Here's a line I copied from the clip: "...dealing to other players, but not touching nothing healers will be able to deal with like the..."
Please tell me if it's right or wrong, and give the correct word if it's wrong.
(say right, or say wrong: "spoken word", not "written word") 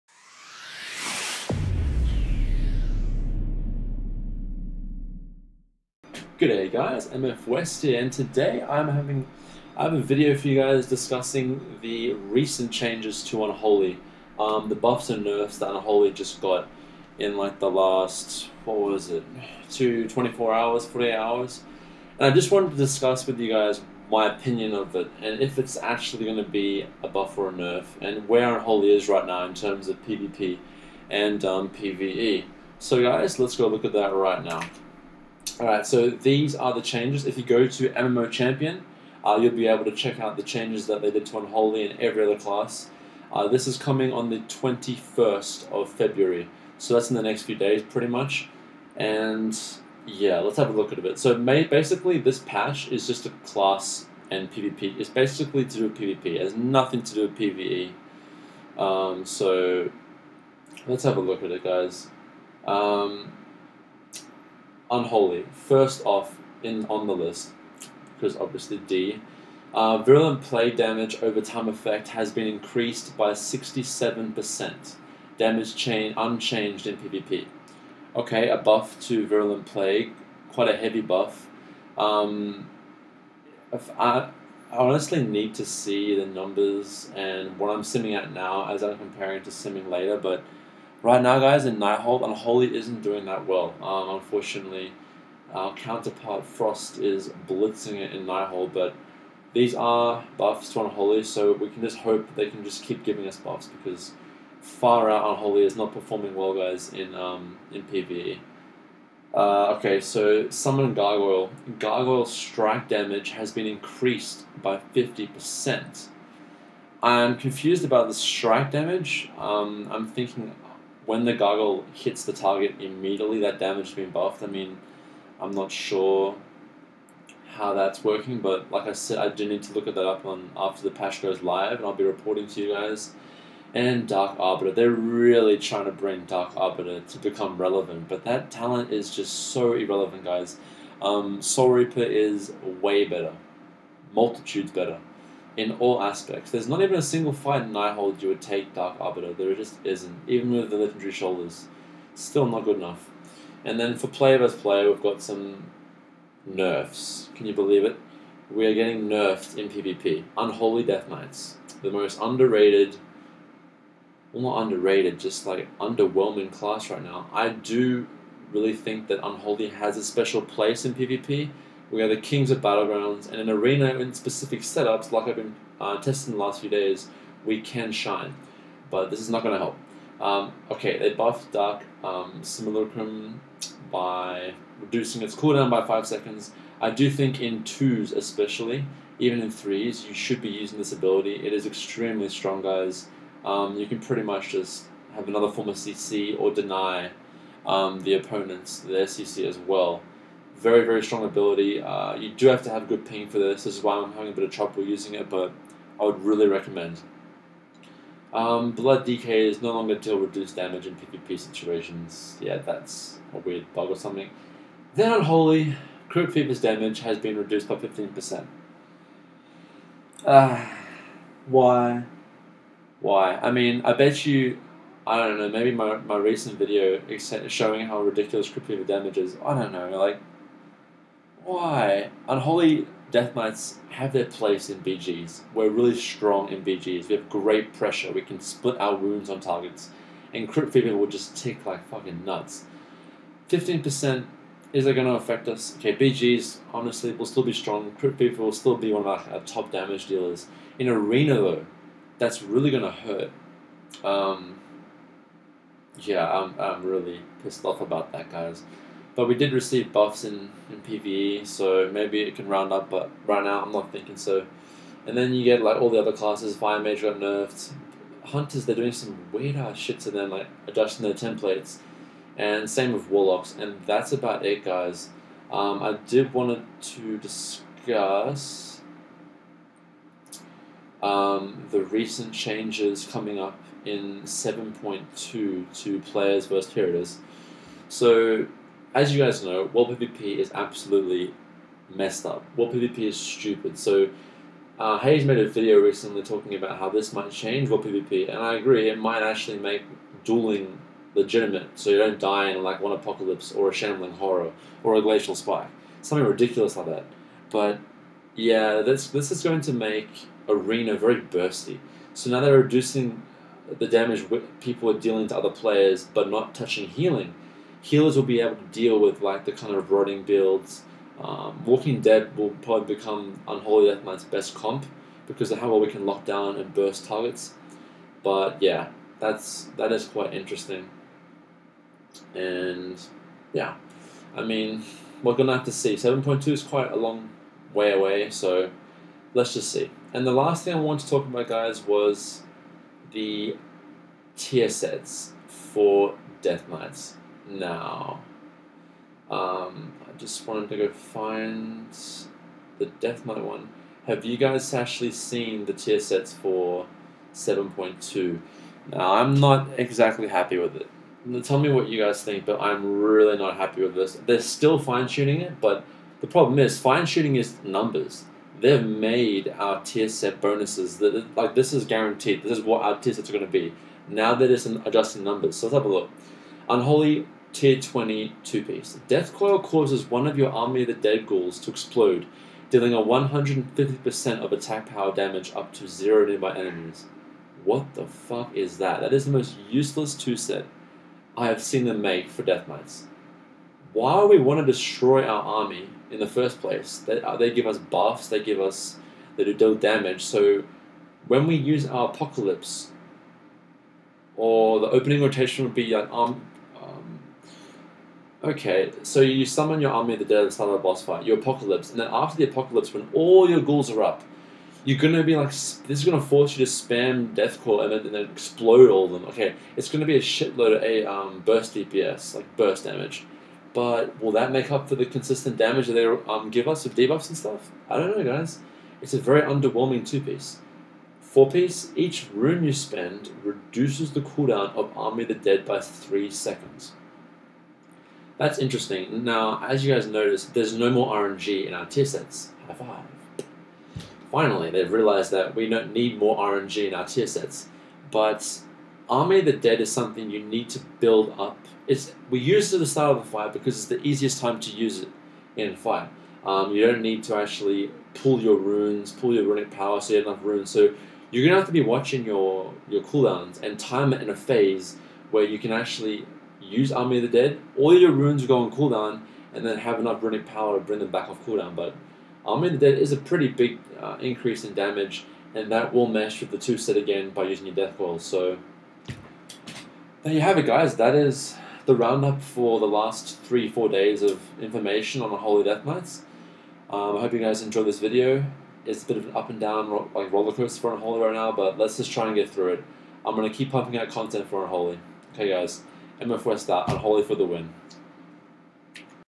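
wrong: "healing", not "nothing".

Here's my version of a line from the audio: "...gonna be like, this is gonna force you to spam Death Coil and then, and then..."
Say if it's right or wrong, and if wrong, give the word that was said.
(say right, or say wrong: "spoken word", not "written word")
right.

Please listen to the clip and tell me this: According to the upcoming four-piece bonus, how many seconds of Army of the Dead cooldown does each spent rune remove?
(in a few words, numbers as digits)
3 seconds.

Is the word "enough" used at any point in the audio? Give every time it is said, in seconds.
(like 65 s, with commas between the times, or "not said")
152 s, 460 s, 469 s.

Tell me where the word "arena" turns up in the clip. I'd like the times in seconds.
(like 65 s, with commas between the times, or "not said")
173 s, 250 s, 310 s.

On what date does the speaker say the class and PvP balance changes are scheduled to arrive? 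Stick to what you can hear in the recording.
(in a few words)
21st of February.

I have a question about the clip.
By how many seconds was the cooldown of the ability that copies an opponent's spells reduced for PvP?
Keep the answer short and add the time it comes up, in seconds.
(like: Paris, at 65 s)
5 seconds, at 185 s.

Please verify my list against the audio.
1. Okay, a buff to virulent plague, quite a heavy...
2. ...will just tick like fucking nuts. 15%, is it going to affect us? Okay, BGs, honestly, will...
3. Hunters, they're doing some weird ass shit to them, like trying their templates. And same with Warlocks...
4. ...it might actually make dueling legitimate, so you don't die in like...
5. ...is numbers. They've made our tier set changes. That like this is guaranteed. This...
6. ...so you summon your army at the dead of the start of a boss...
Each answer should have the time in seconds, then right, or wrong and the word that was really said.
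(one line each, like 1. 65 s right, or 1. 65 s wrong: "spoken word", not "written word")
1. 78 s right
2. 240 s right
3. 268 s wrong: "adjusting", not "trying"
4. 298 s right
5. 367 s wrong: "bonuses", not "changes"
6. 409 s right.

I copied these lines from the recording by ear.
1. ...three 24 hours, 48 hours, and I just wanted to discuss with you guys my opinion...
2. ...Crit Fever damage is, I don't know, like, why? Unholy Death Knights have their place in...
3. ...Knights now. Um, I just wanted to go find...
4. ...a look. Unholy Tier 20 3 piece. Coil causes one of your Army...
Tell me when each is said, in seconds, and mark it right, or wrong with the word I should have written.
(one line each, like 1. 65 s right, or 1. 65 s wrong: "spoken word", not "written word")
1. 19 s wrong: "two", not "three"
2. 228 s right
3. 346 s right
4. 375 s wrong: "2", not "3".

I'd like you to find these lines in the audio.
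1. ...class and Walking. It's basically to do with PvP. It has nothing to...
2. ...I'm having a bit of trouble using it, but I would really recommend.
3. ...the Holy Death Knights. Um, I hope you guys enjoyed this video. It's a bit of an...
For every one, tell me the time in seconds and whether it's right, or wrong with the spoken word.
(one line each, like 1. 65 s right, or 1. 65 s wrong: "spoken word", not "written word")
1. 53 s wrong: "PvP", not "Walking"
2. 203 s right
3. 485 s right.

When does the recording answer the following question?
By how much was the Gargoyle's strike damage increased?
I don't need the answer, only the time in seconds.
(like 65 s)
114 s.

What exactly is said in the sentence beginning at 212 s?
Yeah, that's a weird bug or something.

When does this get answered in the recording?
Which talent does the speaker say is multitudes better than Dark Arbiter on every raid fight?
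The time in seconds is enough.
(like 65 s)
141 s.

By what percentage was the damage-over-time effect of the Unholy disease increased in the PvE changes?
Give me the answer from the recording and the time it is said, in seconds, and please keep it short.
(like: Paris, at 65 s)
67%, at 73 s.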